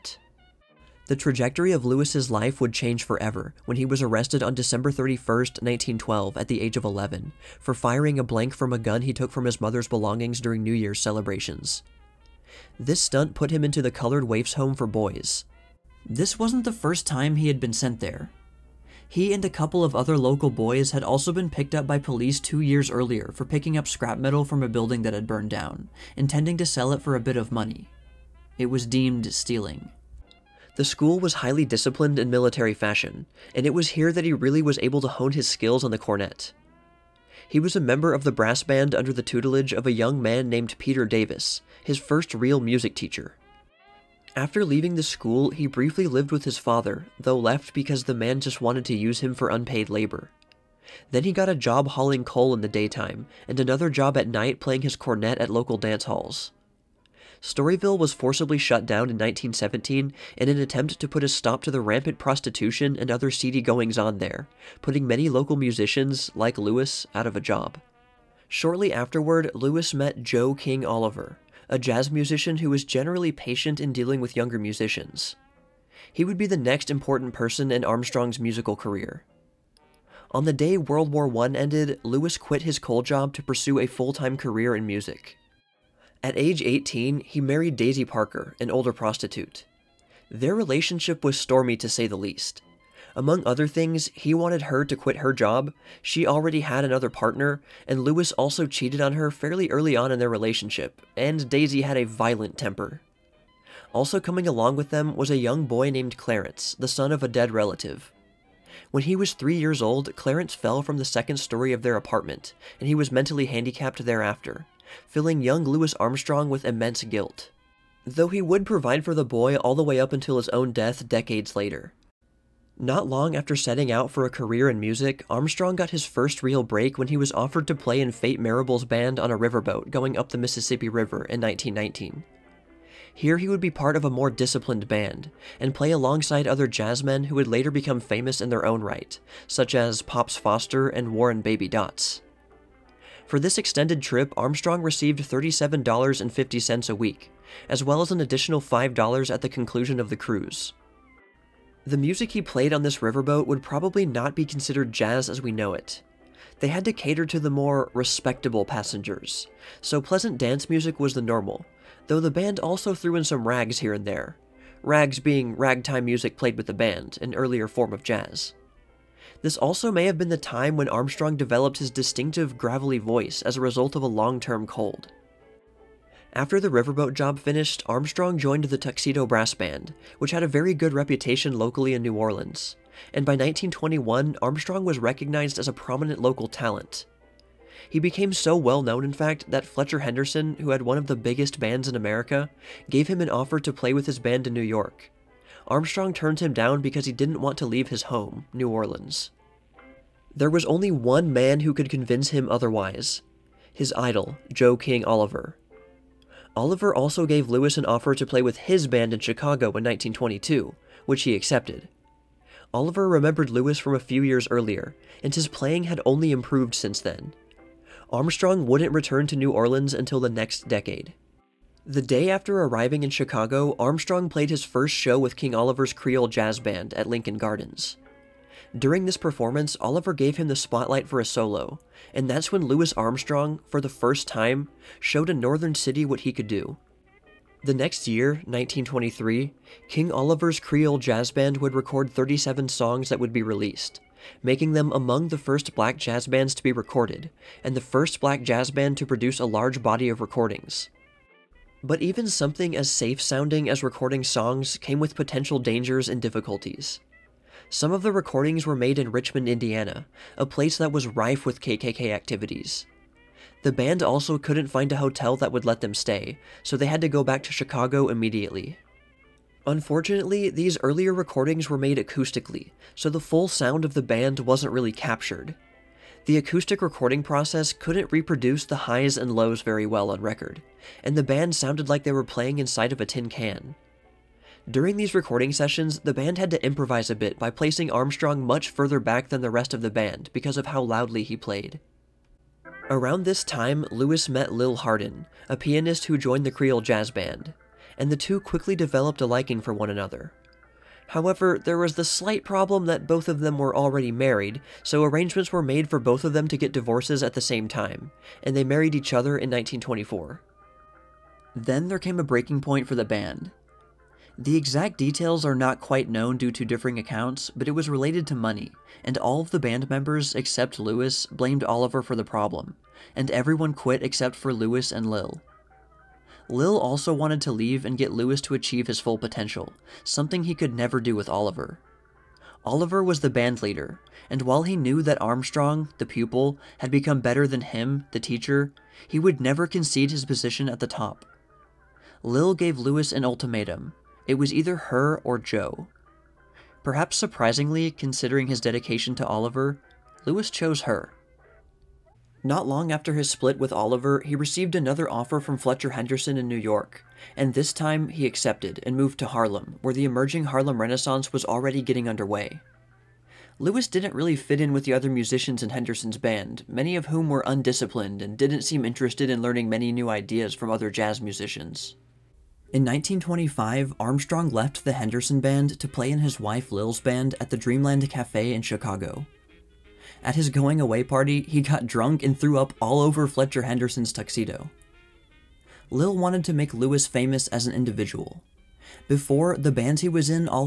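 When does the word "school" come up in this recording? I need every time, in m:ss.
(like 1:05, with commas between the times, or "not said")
0:30, 0:45.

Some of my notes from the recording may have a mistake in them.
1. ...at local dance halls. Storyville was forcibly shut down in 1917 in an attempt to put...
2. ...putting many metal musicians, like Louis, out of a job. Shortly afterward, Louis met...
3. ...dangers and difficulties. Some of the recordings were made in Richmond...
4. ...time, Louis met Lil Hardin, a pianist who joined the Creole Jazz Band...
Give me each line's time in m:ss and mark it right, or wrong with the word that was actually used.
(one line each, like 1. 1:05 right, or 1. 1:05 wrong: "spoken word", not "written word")
1. 0:55 right
2. 1:04 wrong: "local", not "metal"
3. 4:15 right
4. 4:53 right.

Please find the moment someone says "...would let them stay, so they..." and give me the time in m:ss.
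4:25.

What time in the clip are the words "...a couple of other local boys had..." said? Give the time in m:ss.
0:19.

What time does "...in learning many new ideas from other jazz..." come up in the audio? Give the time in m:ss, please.
6:09.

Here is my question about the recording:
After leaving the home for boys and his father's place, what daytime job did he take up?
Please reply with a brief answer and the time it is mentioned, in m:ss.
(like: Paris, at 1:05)
hauling coal, at 0:51.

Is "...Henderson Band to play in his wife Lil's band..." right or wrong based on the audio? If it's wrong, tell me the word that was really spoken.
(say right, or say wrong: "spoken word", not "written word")
right.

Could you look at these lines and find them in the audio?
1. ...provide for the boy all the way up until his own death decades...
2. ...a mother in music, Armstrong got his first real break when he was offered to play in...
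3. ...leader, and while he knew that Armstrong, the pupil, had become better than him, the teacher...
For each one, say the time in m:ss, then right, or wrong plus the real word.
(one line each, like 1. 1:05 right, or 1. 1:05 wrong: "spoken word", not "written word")
1. 1:58 right
2. 2:04 wrong: "career", not "mother"
3. 5:33 right.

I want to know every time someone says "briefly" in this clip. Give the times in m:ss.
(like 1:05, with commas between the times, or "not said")
0:45.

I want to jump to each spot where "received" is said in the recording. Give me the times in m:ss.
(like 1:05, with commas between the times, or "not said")
2:24, 5:54.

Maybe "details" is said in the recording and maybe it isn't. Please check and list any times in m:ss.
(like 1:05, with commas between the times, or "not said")
5:14.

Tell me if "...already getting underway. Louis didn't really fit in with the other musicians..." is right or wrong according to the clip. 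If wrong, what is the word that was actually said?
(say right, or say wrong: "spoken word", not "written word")
right.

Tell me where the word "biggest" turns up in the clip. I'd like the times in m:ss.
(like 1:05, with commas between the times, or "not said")
3:11.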